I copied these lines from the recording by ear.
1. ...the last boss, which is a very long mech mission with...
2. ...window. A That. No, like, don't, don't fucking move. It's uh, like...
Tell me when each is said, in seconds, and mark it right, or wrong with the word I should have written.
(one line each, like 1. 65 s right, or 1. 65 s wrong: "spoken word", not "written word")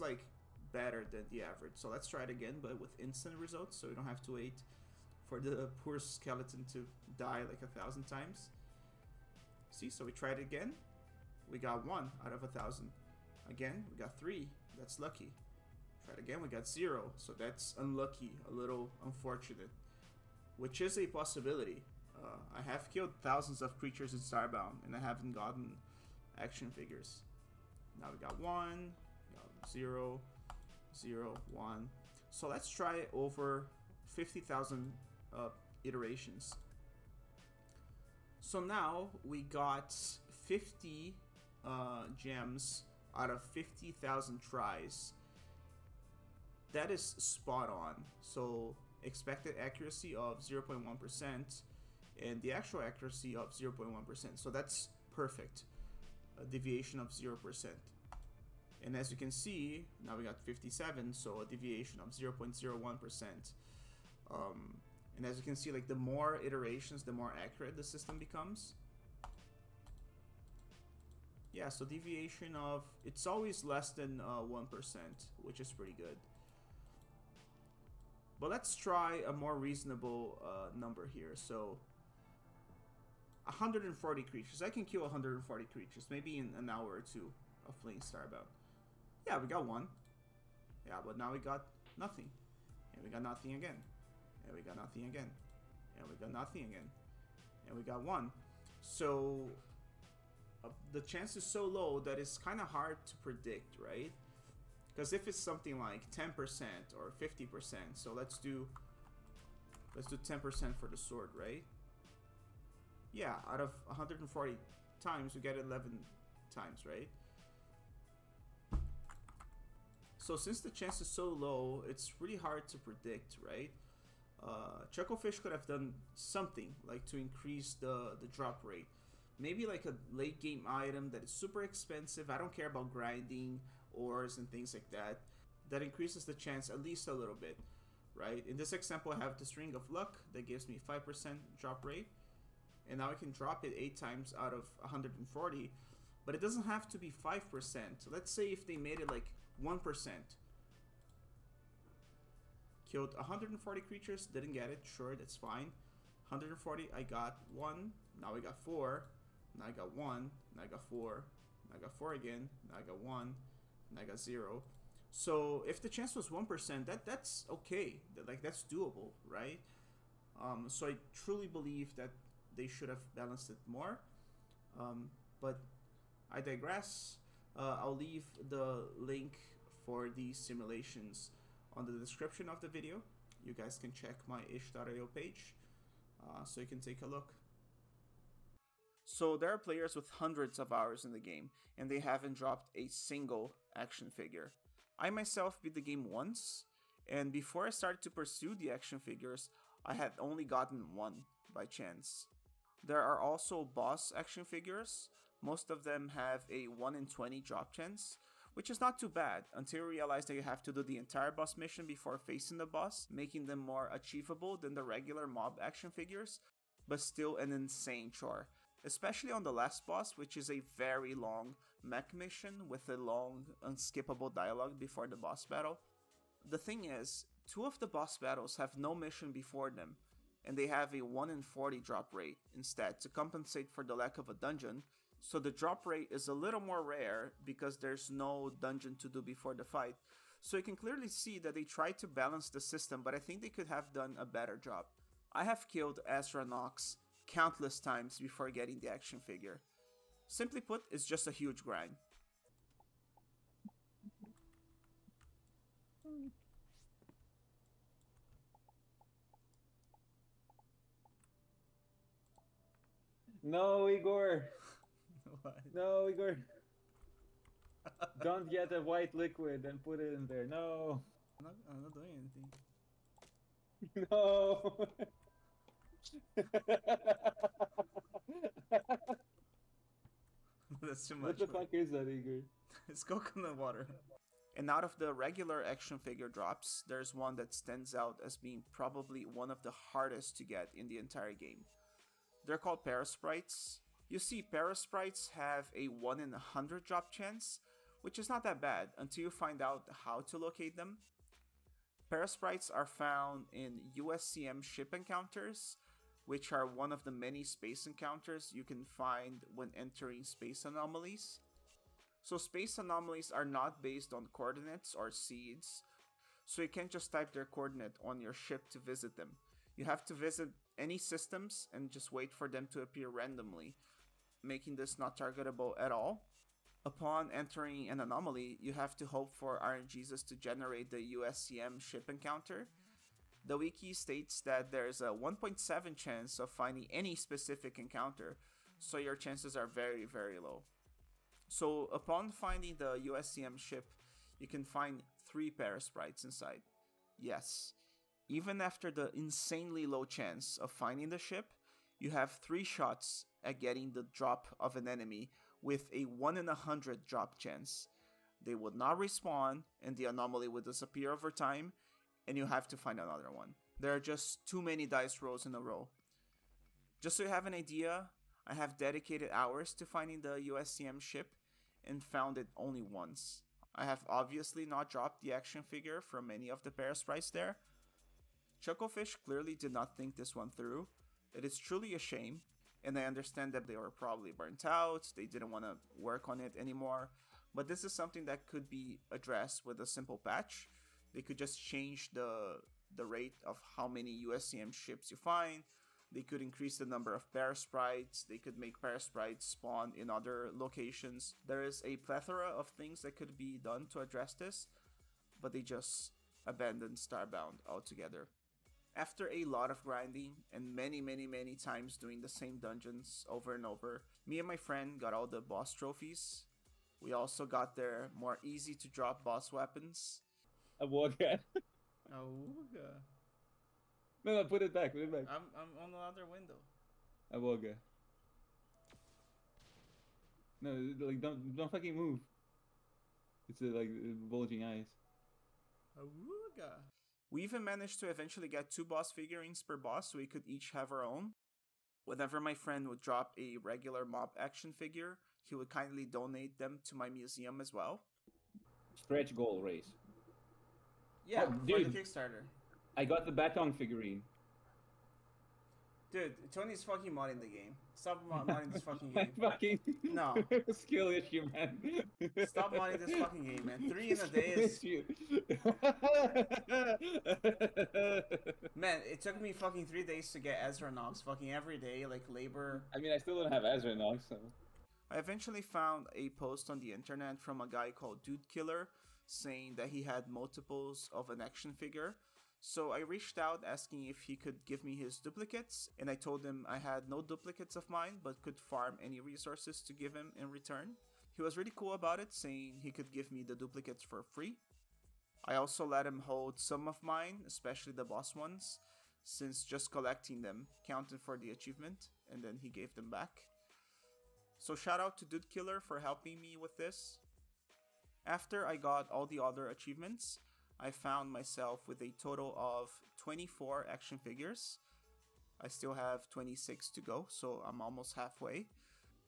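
1. 219 s right
2. 426 s wrong: "Wooga", not "That".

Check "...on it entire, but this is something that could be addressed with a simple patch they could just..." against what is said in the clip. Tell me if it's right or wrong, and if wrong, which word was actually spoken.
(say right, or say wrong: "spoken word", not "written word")
wrong: "anymore", not "entire".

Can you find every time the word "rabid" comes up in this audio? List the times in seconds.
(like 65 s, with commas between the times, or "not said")
not said.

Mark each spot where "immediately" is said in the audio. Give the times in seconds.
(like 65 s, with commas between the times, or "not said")
not said.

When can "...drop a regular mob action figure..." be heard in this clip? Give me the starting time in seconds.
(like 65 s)
443 s.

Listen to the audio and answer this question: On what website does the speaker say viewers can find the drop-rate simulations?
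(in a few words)
itch.io.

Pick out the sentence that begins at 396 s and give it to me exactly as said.
They could increase the number of sprites.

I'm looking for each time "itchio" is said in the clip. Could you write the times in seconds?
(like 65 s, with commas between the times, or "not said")
184 s.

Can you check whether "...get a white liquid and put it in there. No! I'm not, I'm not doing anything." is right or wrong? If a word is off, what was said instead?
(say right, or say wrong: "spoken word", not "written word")
right.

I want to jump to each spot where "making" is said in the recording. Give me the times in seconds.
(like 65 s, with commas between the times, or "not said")
213 s, 324 s.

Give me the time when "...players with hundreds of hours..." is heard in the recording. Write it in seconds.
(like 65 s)
189 s.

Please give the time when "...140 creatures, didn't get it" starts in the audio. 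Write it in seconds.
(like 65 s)
153 s.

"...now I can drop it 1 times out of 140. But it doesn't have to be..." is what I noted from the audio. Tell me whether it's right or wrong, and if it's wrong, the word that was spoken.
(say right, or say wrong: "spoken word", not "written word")
wrong: "8", not "1".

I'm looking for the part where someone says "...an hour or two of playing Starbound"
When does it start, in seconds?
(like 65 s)
86 s.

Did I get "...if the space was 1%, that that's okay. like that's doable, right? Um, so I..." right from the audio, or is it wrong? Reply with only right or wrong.
wrong.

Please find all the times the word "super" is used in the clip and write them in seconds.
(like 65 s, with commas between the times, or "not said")
131 s.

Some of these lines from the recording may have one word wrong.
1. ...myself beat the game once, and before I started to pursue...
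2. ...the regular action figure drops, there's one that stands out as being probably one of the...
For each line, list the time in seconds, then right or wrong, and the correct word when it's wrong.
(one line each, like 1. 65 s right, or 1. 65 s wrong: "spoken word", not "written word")
1. 195 s right
2. 284 s right.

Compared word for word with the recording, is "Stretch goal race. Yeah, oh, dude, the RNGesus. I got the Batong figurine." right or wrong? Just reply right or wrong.
wrong.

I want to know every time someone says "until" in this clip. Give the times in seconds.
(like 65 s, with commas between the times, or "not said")
209 s, 298 s.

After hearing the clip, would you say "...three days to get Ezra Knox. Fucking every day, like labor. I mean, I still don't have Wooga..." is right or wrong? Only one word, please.
wrong.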